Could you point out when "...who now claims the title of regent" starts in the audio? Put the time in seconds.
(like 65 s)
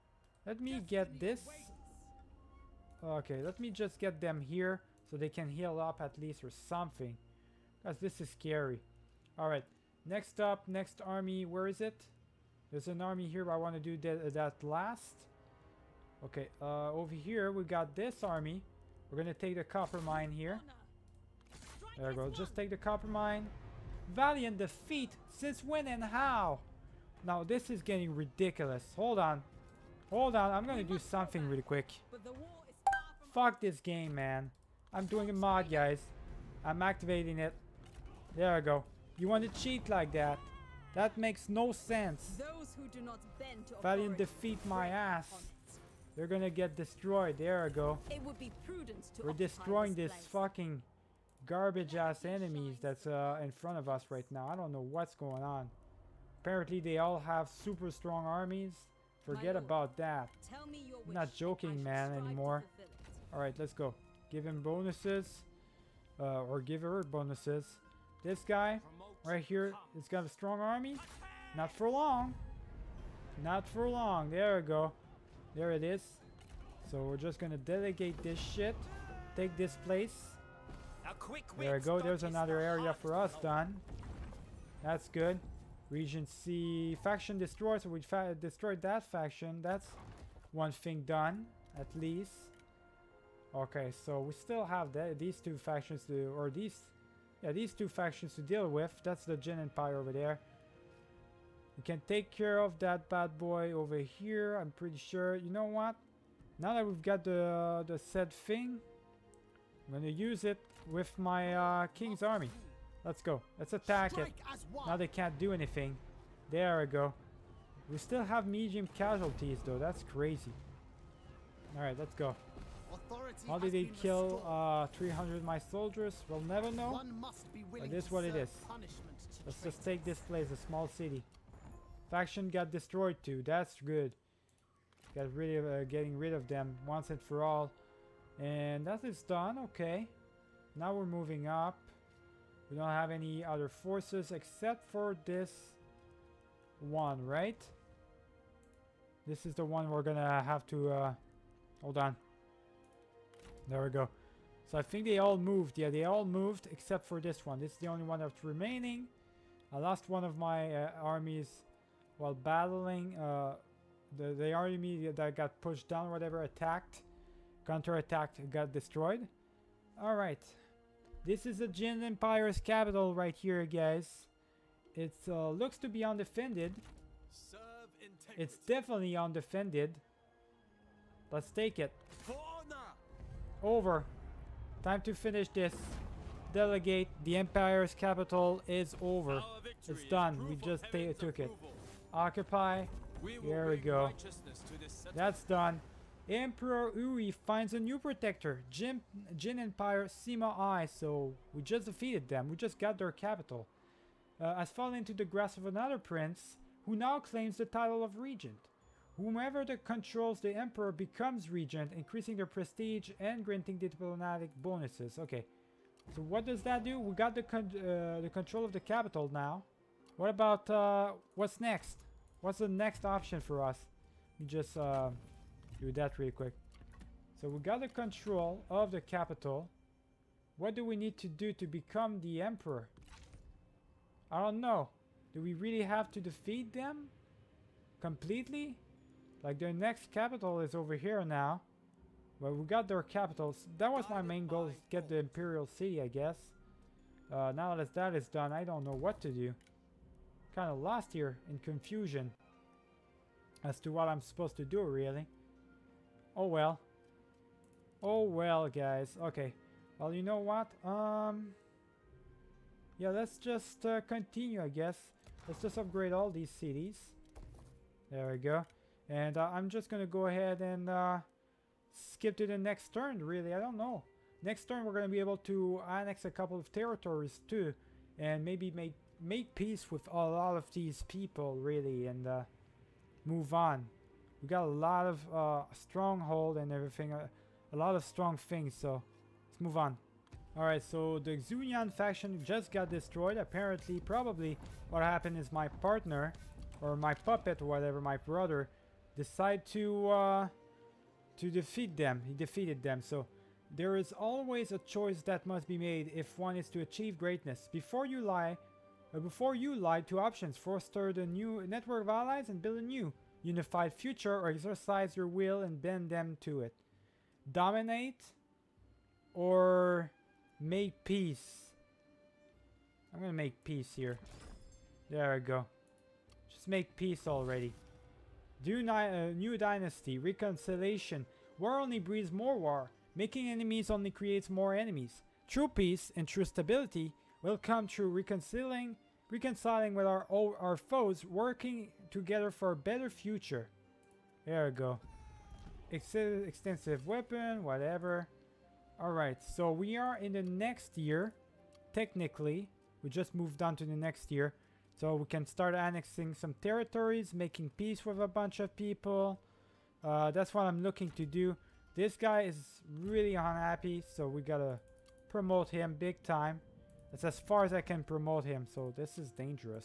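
206 s.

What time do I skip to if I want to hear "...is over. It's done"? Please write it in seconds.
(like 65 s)
188 s.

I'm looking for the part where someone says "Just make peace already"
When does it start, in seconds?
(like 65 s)
326 s.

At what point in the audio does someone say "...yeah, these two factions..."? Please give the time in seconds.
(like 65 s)
97 s.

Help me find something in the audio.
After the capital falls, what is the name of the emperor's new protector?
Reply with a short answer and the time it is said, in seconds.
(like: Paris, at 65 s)
Sima Ai, at 200 s.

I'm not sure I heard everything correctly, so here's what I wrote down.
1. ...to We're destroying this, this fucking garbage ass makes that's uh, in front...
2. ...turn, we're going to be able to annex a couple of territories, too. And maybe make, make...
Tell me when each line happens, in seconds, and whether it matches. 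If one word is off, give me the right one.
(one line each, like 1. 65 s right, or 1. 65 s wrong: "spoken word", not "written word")
1. 49 s wrong: "enemies", not "makes"
2. 274 s right.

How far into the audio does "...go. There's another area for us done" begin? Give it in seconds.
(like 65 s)
81 s.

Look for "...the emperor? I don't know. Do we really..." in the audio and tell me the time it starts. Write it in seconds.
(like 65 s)
232 s.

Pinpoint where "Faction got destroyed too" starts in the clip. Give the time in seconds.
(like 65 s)
132 s.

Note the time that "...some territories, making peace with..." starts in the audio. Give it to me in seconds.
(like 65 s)
356 s.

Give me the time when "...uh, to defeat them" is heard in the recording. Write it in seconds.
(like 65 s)
300 s.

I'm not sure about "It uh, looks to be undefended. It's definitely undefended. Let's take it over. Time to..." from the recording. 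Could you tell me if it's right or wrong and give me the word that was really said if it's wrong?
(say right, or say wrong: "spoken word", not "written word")
right.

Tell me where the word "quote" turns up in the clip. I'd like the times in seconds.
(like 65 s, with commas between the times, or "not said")
not said.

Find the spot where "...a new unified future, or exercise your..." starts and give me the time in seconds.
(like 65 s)
312 s.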